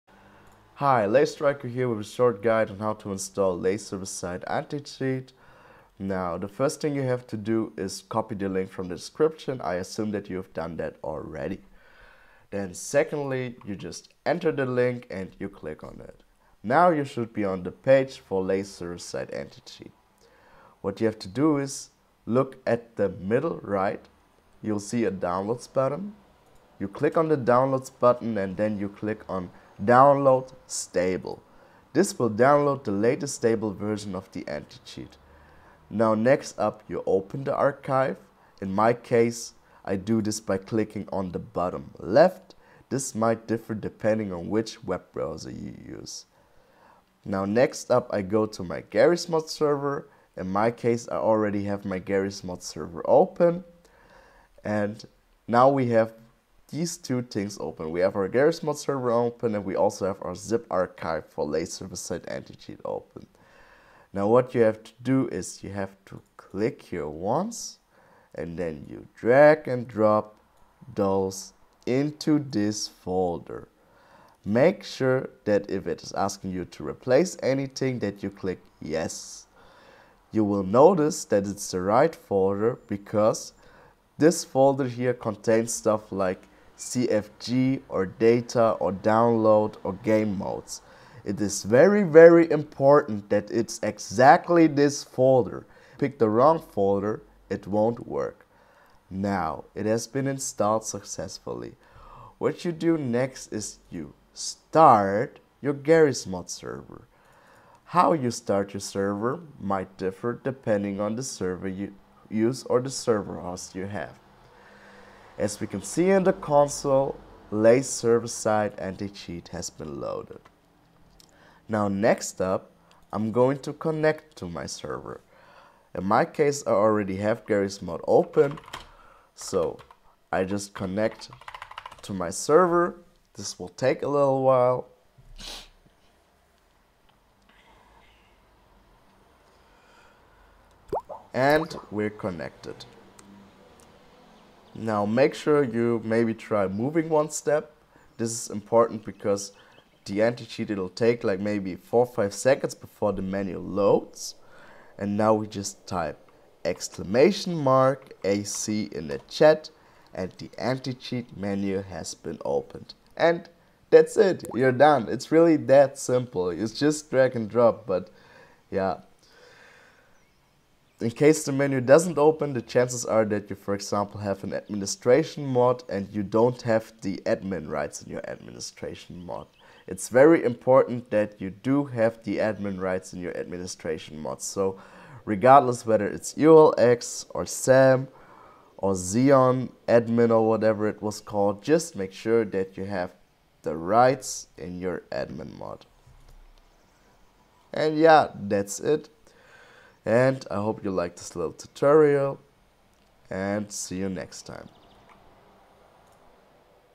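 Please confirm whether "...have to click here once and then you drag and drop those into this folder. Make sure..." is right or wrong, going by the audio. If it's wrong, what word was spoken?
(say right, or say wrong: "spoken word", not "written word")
right.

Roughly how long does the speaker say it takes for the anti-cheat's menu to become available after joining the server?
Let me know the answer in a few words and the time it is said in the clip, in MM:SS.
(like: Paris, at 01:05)
4-5 seconds, at 02:31.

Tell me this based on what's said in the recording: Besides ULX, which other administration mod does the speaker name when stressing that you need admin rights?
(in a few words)
SAM.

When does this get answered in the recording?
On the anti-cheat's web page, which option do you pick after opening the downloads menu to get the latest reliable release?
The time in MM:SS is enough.
00:29.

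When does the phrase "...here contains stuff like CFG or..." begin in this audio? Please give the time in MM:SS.
01:24.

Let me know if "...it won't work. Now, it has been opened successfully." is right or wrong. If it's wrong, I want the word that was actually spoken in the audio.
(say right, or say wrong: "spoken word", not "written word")
wrong: "installed", not "opened".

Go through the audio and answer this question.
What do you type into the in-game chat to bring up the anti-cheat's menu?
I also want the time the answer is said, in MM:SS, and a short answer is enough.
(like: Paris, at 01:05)
!ac, at 02:36.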